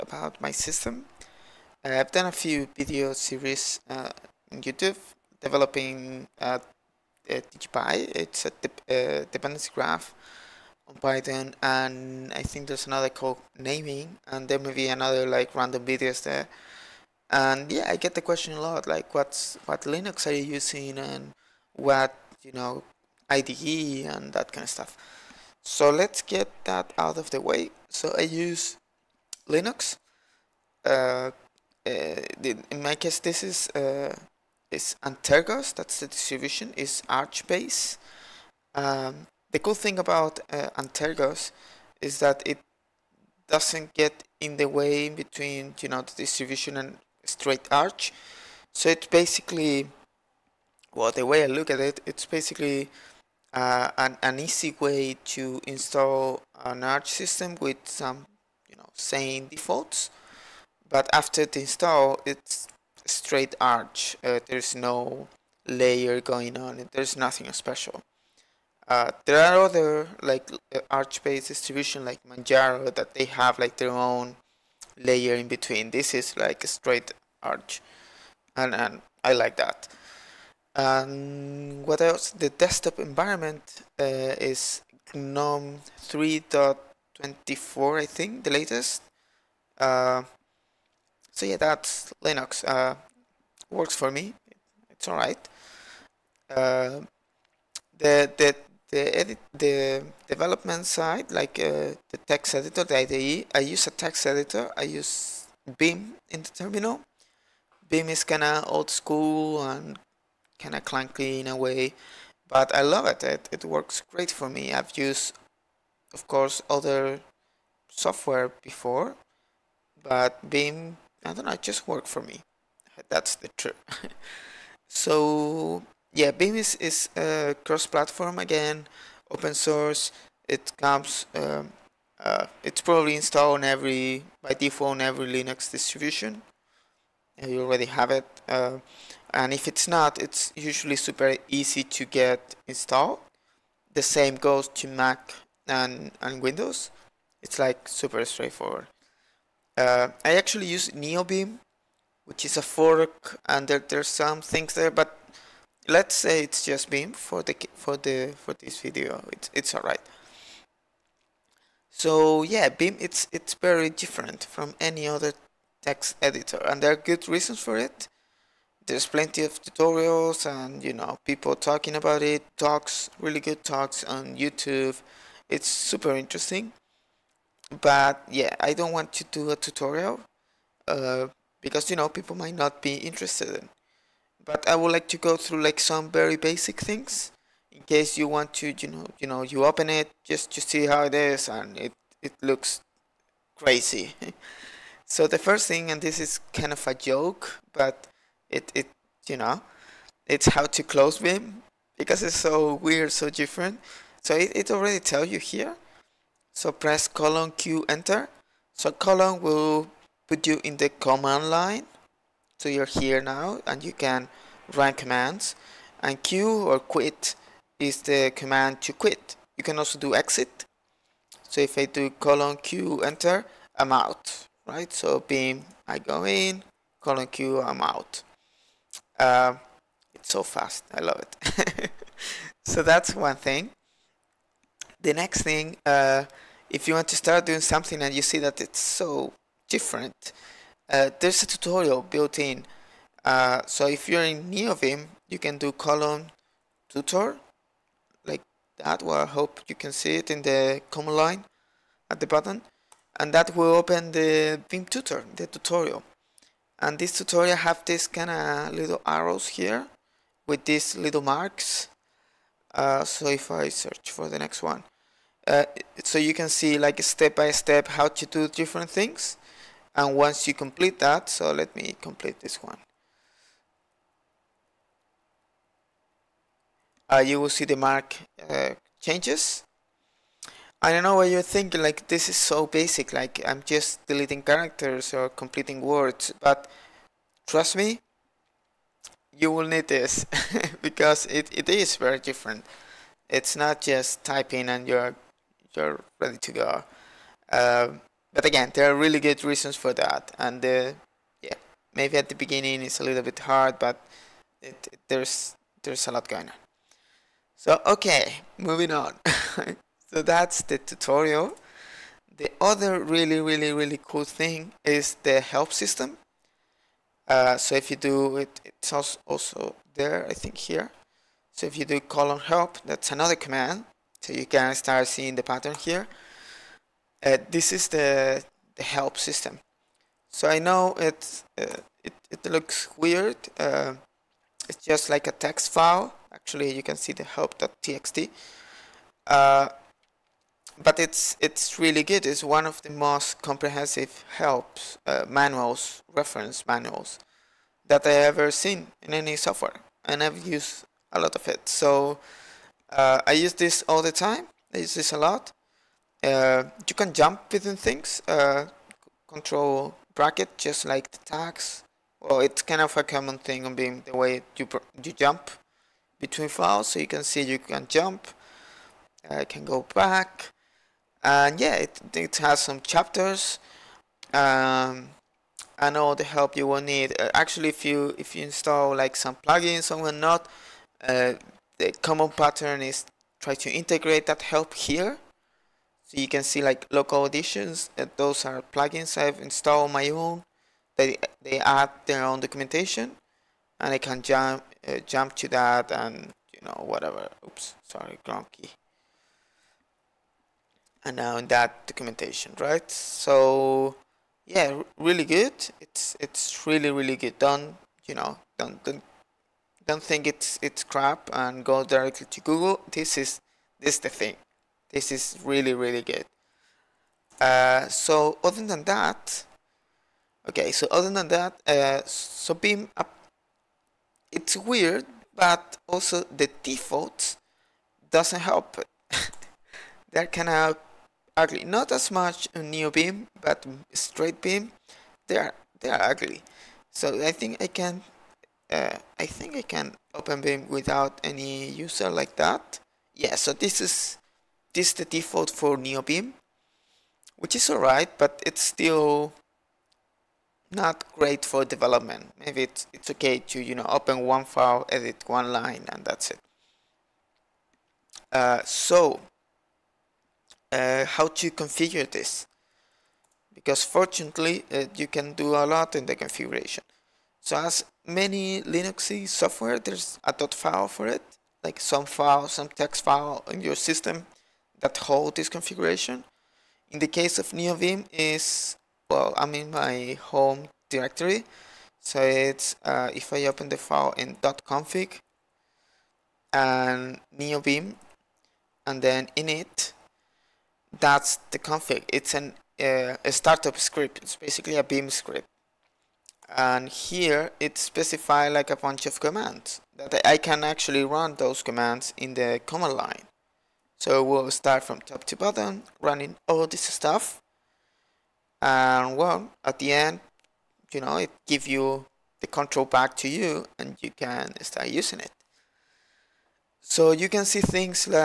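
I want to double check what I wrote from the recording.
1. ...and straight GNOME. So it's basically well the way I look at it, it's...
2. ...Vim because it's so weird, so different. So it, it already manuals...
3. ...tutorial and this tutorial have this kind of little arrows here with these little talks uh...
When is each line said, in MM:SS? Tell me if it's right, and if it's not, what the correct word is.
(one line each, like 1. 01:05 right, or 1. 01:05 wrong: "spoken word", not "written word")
1. 00:46 wrong: "Arch", not "GNOME"
2. 03:21 wrong: "tells", not "manuals"
3. 04:15 wrong: "marks", not "talks".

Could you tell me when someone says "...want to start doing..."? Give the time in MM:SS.
03:56.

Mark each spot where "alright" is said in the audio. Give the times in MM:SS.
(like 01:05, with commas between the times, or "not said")
02:39, 07:27.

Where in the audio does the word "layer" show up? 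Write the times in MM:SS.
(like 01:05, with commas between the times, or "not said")
01:05, 01:14.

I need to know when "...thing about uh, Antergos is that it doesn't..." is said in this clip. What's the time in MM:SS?
00:39.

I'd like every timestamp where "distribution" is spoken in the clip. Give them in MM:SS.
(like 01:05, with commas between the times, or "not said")
00:36, 00:46, 01:11, 02:15.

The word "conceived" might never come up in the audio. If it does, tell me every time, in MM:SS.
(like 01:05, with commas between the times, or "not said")
not said.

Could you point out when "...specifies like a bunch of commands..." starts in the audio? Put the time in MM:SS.
08:17.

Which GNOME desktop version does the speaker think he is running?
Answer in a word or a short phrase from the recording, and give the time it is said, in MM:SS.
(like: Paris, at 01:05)
3.24, at 01:26.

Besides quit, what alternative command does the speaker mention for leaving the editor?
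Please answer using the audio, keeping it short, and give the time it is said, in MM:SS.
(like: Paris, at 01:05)
exit, at 03:40.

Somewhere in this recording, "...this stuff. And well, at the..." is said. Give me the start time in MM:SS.
08:26.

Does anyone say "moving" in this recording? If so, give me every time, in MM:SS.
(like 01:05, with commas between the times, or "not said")
05:08.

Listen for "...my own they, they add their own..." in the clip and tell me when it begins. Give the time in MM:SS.
06:29.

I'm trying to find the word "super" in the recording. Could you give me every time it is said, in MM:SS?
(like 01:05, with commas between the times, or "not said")
02:20, 02:27, 02:55.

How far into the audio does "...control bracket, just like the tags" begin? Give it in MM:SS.
05:59.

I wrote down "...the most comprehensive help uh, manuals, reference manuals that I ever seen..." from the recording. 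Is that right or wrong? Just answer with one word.
right.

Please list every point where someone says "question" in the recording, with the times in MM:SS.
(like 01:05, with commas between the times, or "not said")
00:18.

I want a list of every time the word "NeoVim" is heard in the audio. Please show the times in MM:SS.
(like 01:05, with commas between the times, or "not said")
02:30, 04:04, 07:12, 07:25, 07:57, 08:07.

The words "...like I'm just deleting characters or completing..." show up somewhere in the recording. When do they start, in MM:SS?
04:43.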